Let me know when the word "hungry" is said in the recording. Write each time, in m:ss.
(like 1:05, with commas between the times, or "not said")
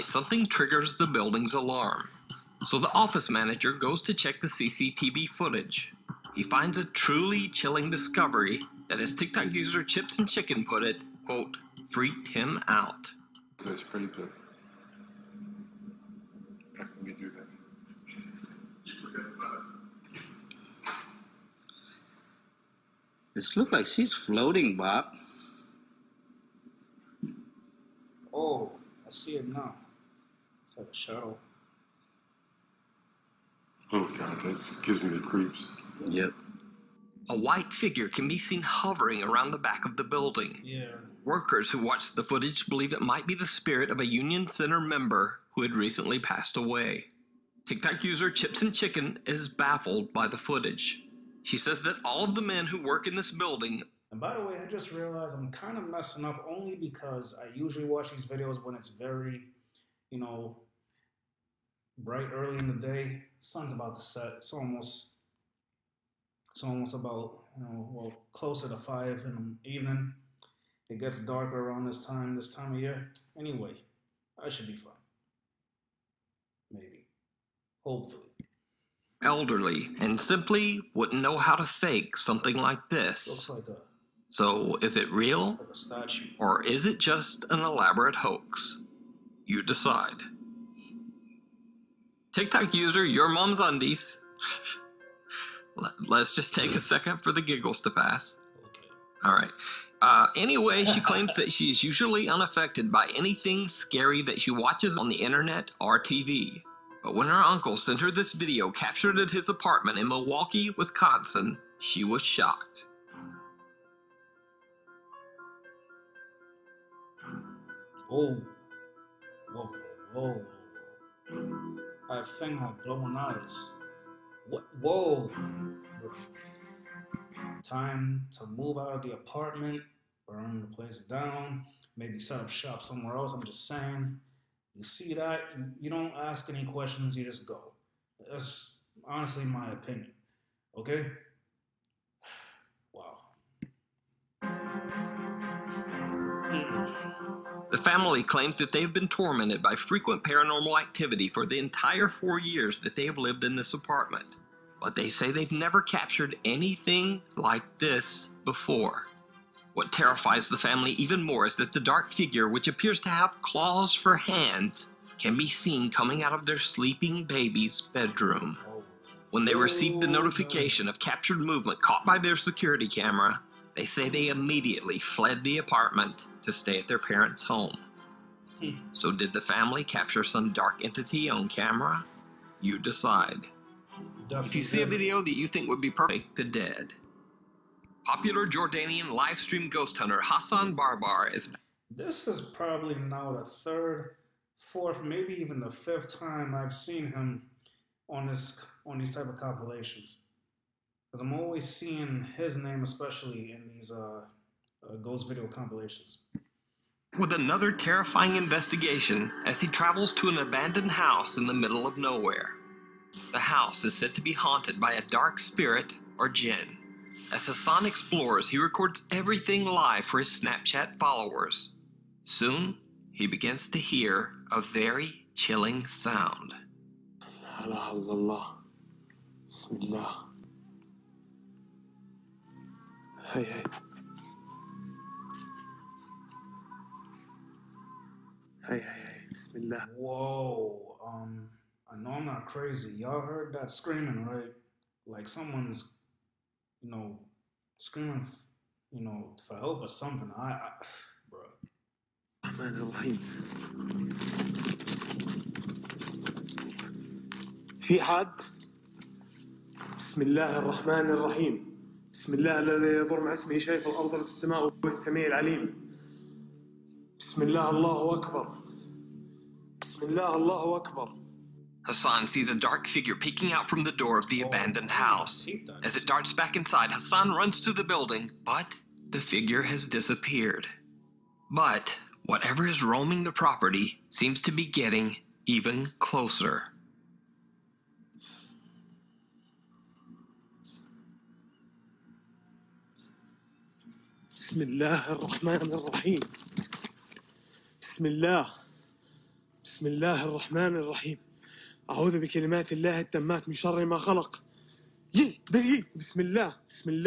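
not said.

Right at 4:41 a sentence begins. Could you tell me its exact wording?
But whatever is roaming the property seems to be getting even closer.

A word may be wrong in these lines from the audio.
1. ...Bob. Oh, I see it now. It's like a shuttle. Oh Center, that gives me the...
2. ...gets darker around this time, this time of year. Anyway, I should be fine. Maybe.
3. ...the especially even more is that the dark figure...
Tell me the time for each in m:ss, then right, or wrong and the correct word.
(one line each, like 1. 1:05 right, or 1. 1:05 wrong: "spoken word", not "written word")
1. 0:24 wrong: "God", not "Center"
2. 1:11 right
3. 2:40 wrong: "family", not "especially".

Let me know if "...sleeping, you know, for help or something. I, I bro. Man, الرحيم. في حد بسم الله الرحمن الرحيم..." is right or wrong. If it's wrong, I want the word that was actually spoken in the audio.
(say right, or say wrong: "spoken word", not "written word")
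wrong: "screaming", not "sleeping".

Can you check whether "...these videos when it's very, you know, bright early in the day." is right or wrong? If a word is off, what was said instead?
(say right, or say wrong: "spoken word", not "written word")
right.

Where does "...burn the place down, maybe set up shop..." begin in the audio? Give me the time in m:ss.
2:10.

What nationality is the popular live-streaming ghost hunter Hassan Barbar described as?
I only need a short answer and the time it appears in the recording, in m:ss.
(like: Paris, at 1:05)
Jordanian, at 3:08.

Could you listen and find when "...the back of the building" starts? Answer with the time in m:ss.
0:39.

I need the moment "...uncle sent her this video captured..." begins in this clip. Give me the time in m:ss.
1:47.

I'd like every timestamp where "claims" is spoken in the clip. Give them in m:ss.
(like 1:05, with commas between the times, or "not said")
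1:41, 2:28.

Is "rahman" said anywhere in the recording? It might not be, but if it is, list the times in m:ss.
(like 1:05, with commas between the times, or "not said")
4:54, 5:00.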